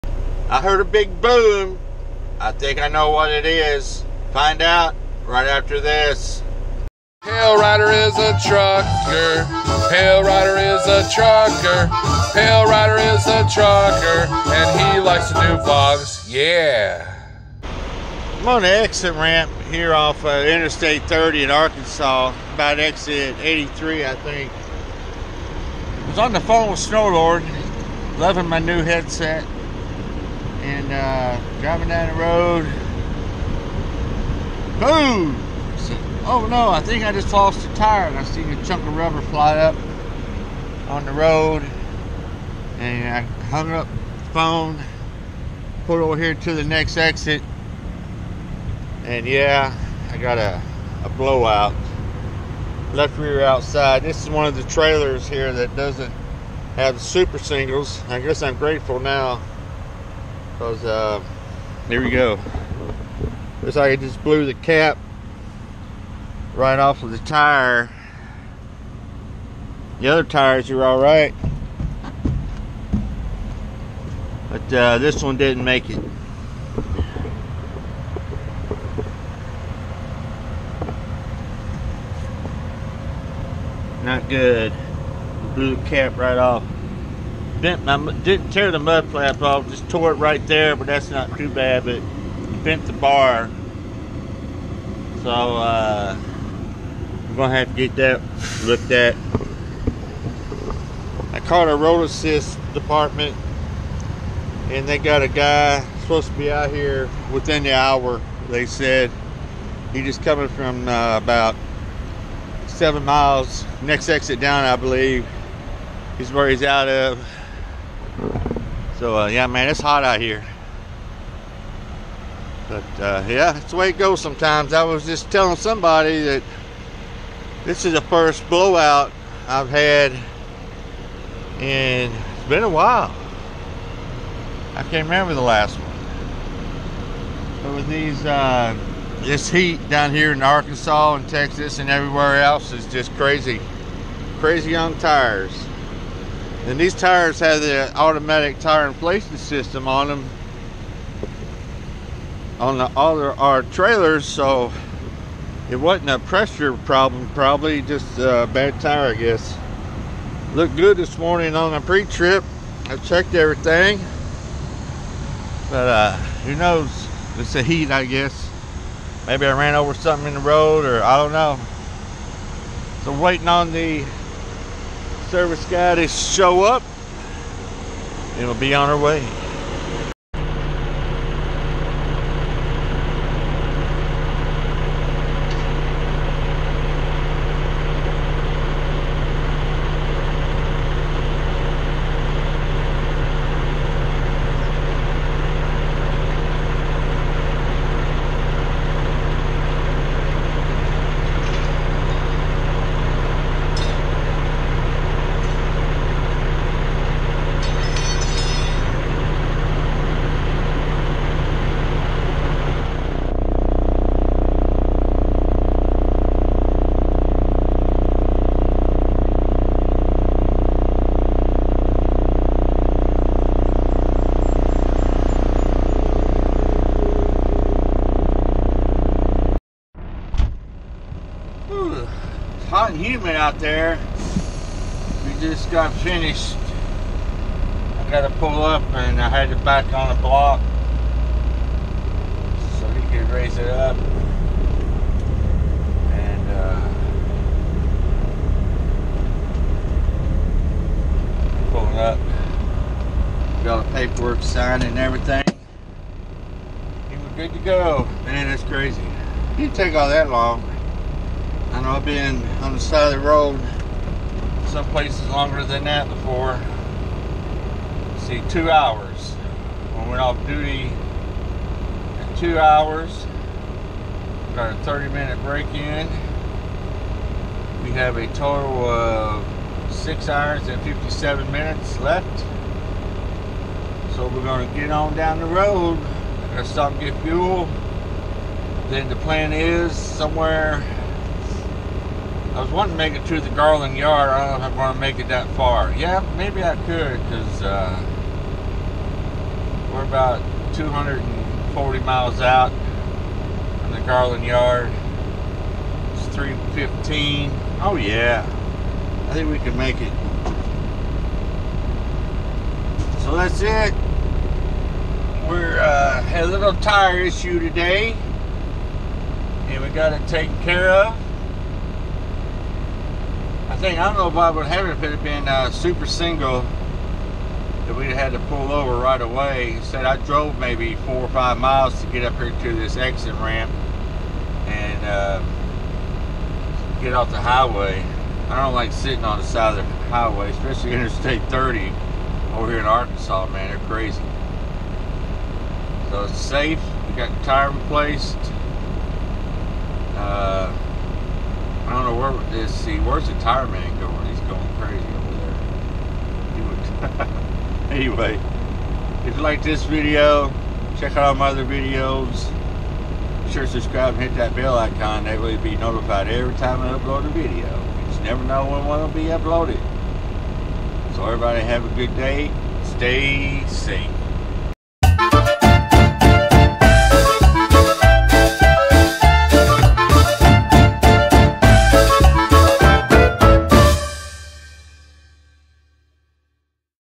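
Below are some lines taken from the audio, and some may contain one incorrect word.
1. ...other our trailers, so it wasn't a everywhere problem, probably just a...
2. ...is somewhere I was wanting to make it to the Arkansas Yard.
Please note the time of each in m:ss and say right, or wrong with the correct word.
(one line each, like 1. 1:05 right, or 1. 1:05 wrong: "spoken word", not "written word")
1. 2:32 wrong: "pressure", not "everywhere"
2. 4:49 wrong: "Garland", not "Arkansas".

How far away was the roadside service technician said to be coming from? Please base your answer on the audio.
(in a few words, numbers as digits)
7 miles.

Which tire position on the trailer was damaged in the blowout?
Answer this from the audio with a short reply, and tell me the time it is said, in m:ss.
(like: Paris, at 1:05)
Left rear outside, at 0:52.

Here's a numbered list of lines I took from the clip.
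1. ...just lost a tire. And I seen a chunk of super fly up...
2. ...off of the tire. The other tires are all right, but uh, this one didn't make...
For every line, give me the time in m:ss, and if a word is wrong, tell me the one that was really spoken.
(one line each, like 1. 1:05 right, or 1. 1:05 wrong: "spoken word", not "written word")
1. 0:37 wrong: "rubber", not "super"
2. 1:06 right.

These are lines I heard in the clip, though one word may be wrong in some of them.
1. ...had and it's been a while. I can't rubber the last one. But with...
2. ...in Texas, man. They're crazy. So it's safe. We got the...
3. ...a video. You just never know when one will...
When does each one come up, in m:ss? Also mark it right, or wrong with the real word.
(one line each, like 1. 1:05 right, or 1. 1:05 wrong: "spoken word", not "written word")
1. 2:09 wrong: "remember", not "rubber"
2. 5:42 wrong: "Arkansas", not "Texas"
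3. 6:07 right.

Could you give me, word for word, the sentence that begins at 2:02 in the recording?
But uh, yeah, that's the way it goes sometimes.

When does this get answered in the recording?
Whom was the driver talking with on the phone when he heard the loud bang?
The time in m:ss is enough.
0:26.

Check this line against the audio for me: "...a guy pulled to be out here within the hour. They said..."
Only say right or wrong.
wrong.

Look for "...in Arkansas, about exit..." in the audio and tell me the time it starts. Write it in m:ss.
0:21.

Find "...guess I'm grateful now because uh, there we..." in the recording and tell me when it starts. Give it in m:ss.
0:58.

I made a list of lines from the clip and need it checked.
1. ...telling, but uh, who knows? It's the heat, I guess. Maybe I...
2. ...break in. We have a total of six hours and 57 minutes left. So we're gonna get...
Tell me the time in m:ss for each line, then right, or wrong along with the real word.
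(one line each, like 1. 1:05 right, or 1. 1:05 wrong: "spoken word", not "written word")
1. 2:43 wrong: "everything", not "telling"
2. 4:35 right.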